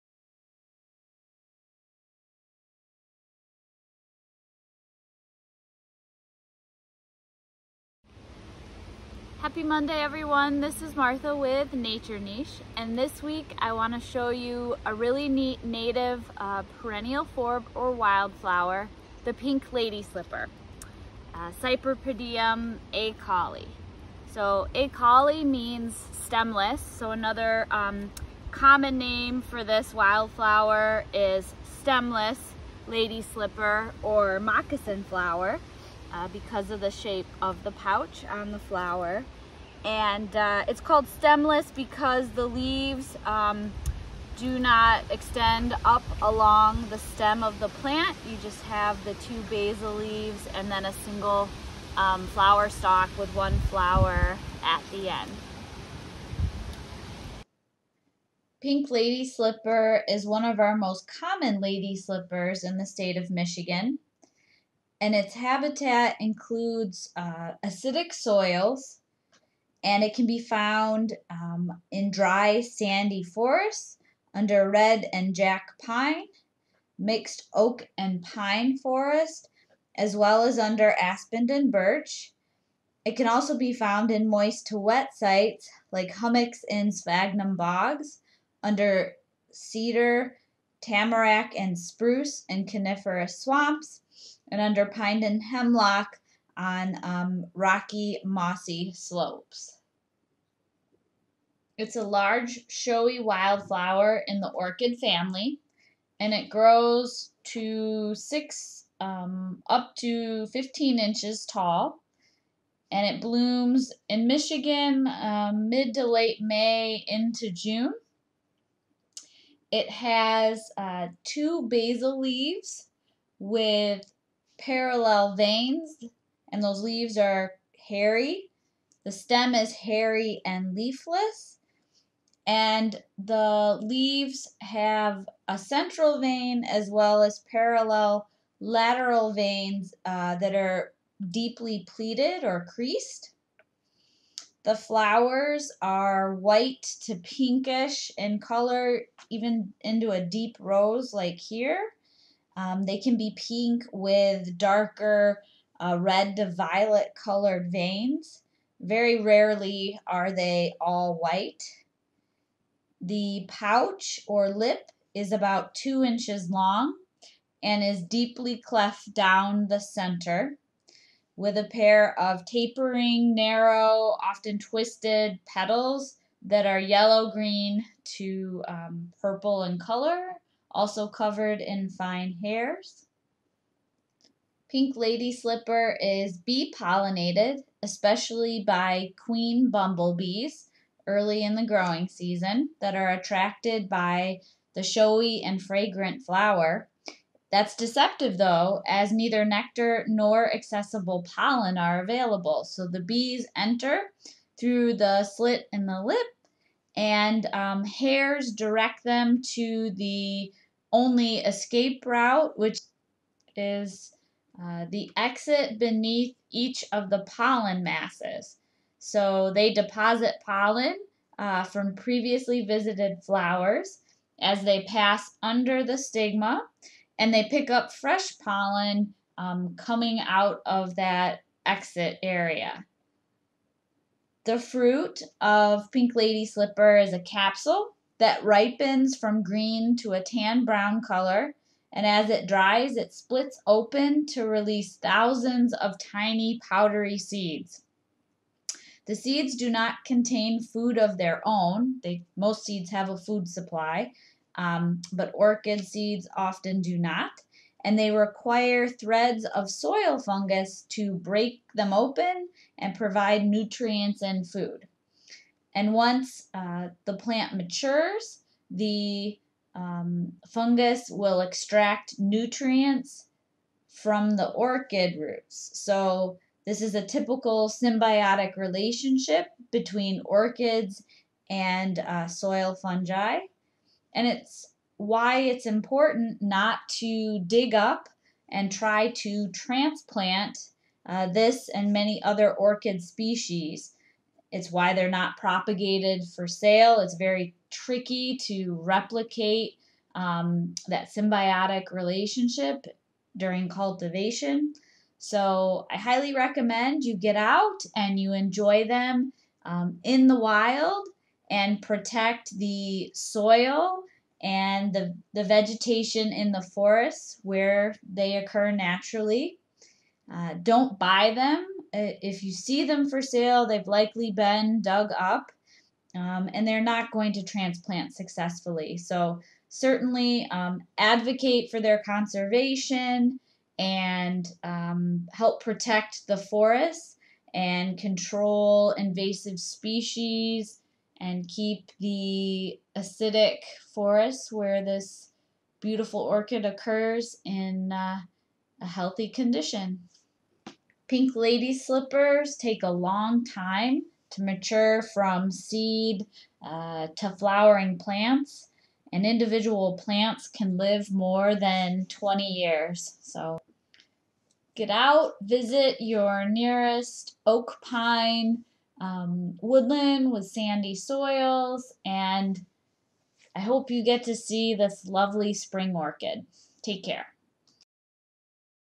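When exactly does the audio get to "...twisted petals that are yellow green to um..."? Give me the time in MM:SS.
02:54.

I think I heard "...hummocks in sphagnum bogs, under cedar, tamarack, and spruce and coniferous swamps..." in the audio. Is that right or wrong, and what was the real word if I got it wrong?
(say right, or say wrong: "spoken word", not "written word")
right.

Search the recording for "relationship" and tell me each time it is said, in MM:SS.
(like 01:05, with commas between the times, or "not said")
04:38, 05:01.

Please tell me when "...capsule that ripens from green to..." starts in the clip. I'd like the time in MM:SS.
03:57.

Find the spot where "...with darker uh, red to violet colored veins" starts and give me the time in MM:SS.
02:33.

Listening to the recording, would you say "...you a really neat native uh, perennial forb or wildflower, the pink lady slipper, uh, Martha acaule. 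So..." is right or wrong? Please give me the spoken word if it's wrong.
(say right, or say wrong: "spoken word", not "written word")
wrong: "Cypripedium", not "Martha".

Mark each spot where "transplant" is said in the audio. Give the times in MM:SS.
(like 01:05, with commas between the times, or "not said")
04:49, 05:27.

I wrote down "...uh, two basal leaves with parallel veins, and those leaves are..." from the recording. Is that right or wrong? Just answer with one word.
right.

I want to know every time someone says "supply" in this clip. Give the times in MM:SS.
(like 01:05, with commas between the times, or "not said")
04:13.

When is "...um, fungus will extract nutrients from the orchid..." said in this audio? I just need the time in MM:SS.
04:29.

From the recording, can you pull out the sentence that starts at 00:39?
And uh, it's called stemless because the leaves um, do not extend up along the stem of the plant.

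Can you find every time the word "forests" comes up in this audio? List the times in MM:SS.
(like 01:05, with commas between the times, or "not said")
01:13, 01:18, 05:16, 05:36, 05:43.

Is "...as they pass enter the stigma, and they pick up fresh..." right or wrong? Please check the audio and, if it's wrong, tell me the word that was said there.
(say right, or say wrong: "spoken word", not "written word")
wrong: "under", not "enter".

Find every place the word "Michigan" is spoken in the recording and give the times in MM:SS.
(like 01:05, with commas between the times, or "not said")
01:03, 01:54.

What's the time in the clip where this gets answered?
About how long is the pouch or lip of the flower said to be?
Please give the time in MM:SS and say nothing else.
02:45.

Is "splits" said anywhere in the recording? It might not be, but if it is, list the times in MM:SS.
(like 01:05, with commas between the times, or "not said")
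04:03.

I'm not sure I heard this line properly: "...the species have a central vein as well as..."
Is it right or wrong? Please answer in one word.
wrong.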